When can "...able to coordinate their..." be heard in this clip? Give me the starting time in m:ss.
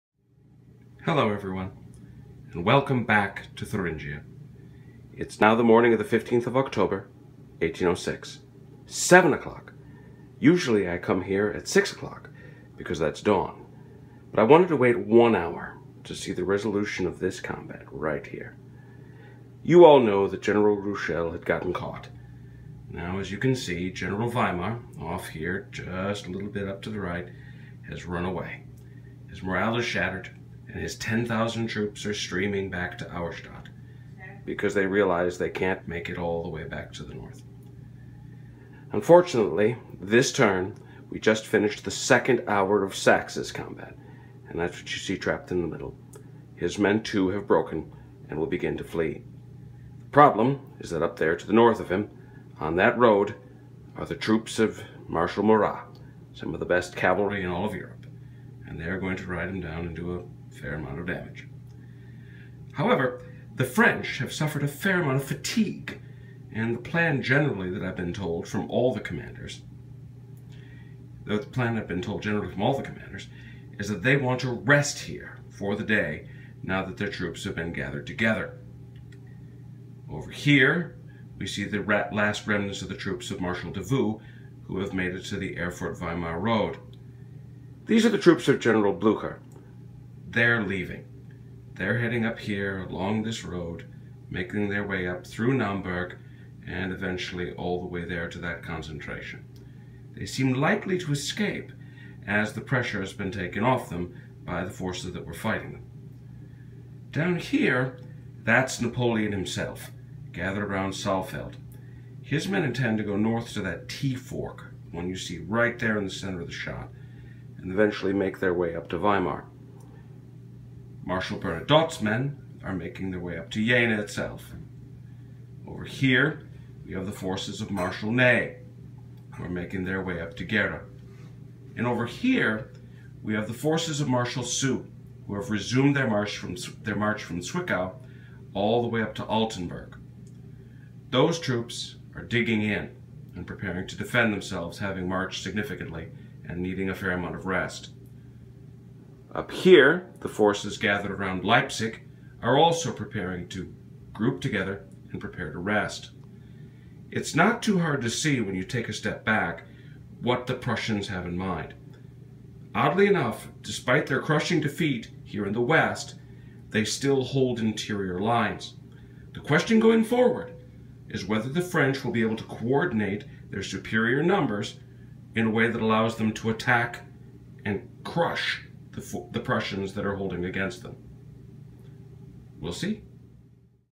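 2:52.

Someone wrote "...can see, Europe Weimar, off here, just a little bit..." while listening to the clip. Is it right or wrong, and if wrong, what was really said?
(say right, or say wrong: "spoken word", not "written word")
wrong: "General", not "Europe".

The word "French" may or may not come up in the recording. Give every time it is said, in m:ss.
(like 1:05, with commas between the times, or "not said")
1:03, 2:51.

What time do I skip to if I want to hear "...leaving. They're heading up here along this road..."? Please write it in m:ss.
1:30.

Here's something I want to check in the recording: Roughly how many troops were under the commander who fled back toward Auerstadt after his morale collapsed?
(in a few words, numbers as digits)
10,000.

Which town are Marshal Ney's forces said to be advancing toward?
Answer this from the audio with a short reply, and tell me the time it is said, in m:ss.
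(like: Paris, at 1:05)
Gera, at 2:10.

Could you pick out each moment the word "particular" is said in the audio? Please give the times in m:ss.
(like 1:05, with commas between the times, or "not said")
not said.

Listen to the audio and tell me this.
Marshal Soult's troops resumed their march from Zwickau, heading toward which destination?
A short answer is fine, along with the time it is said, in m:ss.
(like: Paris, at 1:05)
Altenburg, at 2:19.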